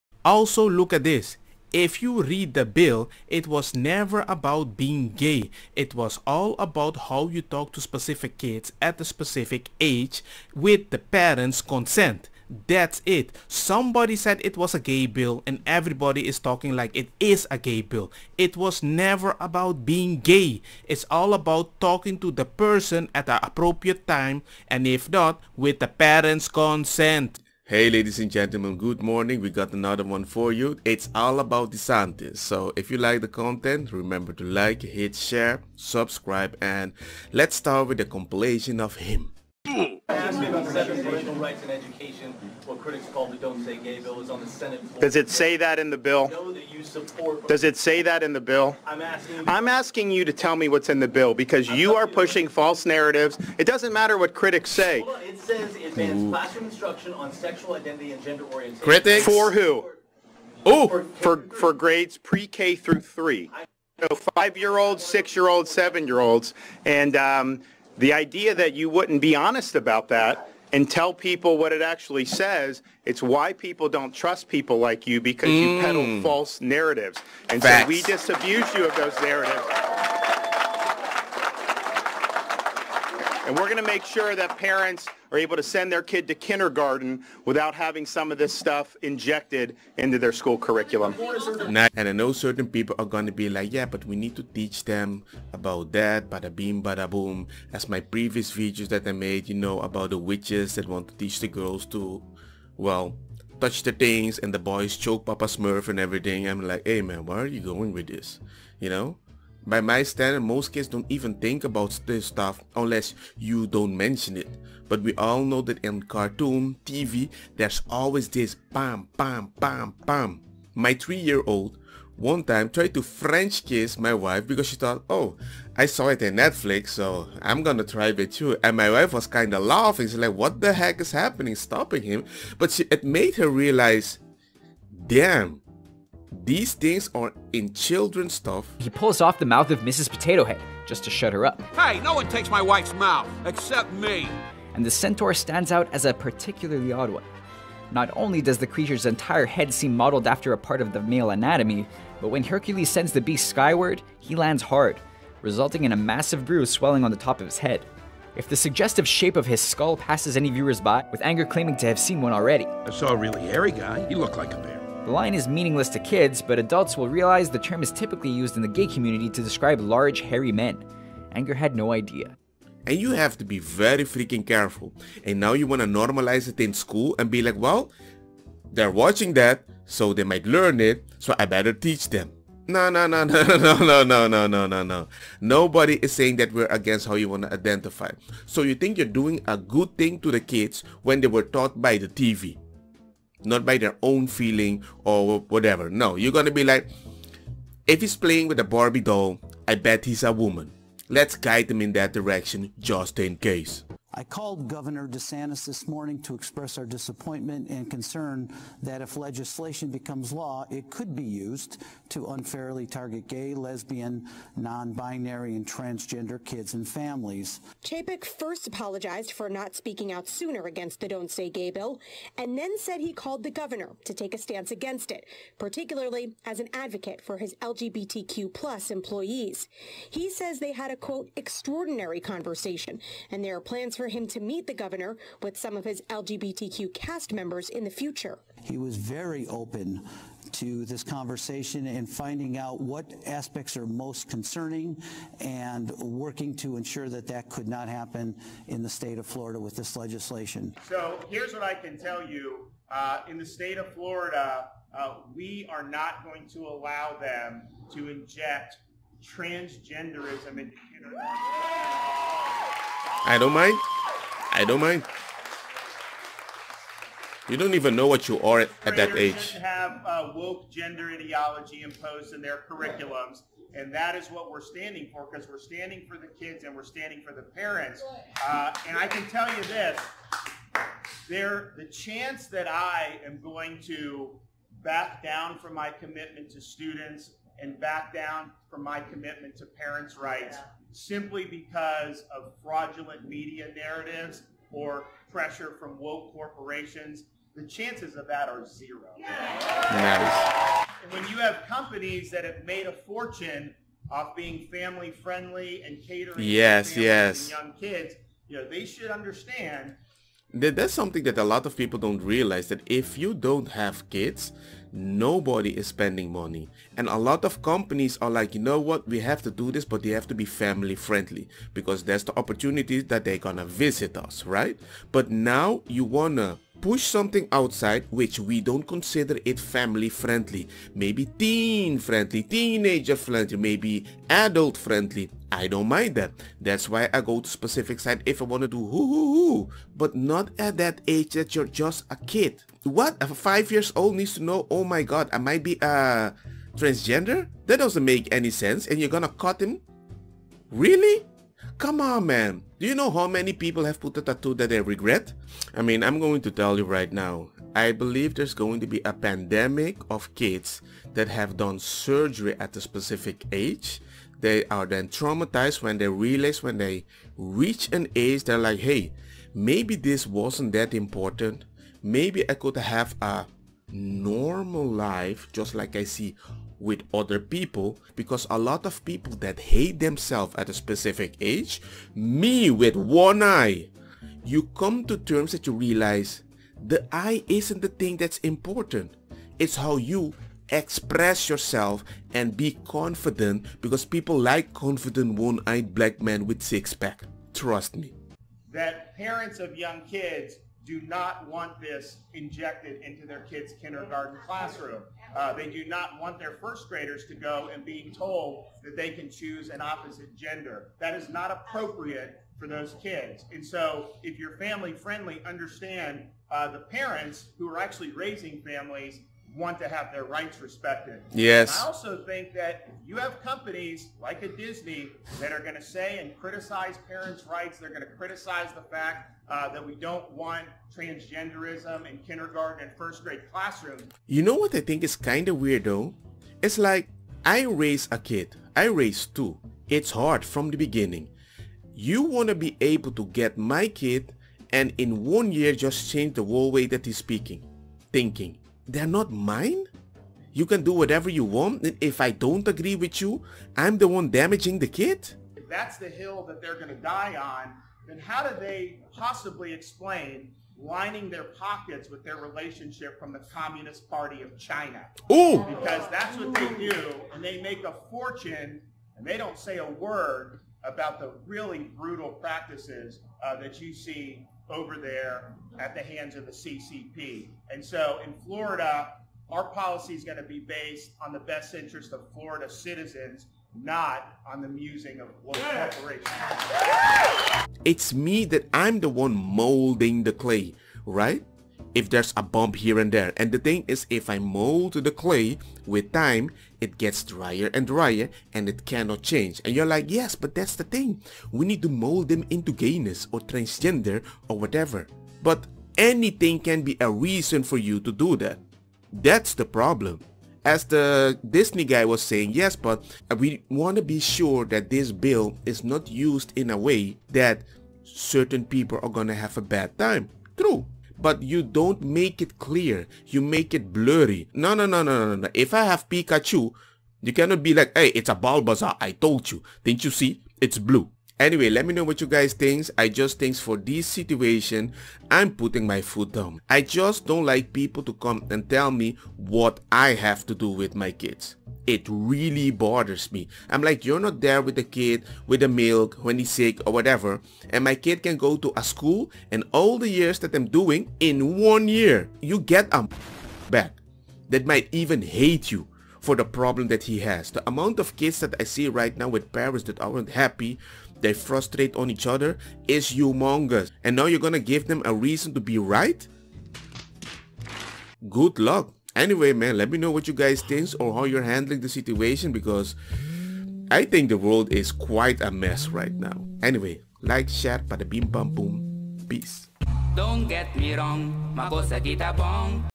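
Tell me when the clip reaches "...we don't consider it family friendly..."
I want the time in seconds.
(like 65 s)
328 s.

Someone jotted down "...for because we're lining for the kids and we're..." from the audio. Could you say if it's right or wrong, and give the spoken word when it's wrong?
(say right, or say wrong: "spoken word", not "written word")
wrong: "standing", not "lining".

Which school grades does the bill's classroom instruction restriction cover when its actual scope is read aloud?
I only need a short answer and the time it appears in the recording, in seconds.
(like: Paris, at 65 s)
pre-K through 3, at 62 s.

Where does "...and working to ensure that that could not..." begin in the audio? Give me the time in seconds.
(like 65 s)
245 s.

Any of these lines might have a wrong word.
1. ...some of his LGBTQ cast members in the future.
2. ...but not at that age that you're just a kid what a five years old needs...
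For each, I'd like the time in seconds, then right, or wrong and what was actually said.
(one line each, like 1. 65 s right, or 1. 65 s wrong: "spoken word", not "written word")
1. 235 s right
2. 339 s right.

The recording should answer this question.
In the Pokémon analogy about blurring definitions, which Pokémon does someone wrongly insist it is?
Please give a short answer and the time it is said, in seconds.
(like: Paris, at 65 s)
Bulbasaur, at 528 s.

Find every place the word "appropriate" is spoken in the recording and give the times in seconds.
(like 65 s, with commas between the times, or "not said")
23 s, 411 s.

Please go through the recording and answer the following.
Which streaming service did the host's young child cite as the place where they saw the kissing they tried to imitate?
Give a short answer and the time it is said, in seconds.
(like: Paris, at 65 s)
Netflix, at 126 s.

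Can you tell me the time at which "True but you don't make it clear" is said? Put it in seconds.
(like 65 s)
520 s.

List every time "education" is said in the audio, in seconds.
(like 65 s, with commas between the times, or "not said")
41 s.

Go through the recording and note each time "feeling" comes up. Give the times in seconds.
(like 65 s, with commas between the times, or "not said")
194 s.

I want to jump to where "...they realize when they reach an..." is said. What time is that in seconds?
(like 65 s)
365 s.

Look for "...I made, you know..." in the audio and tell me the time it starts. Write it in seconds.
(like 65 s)
99 s.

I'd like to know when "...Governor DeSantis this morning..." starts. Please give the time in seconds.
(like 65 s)
204 s.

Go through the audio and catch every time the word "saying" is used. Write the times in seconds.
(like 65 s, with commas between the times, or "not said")
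186 s, 512 s.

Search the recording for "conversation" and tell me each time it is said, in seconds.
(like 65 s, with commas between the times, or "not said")
232 s, 241 s.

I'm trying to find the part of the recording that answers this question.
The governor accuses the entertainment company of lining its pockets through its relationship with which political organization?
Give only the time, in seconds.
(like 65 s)
463 s.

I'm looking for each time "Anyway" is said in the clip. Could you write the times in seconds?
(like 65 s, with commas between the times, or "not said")
531 s, 569 s, 576 s.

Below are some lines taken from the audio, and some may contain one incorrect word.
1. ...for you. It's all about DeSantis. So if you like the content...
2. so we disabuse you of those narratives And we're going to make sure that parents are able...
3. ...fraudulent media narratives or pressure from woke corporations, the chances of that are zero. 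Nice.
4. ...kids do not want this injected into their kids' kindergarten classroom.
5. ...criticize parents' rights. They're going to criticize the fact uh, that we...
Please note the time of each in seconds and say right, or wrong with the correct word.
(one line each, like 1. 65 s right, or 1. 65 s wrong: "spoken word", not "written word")
1. 30 s right
2. 77 s right
3. 292 s right
4. 400 s right
5. 426 s right.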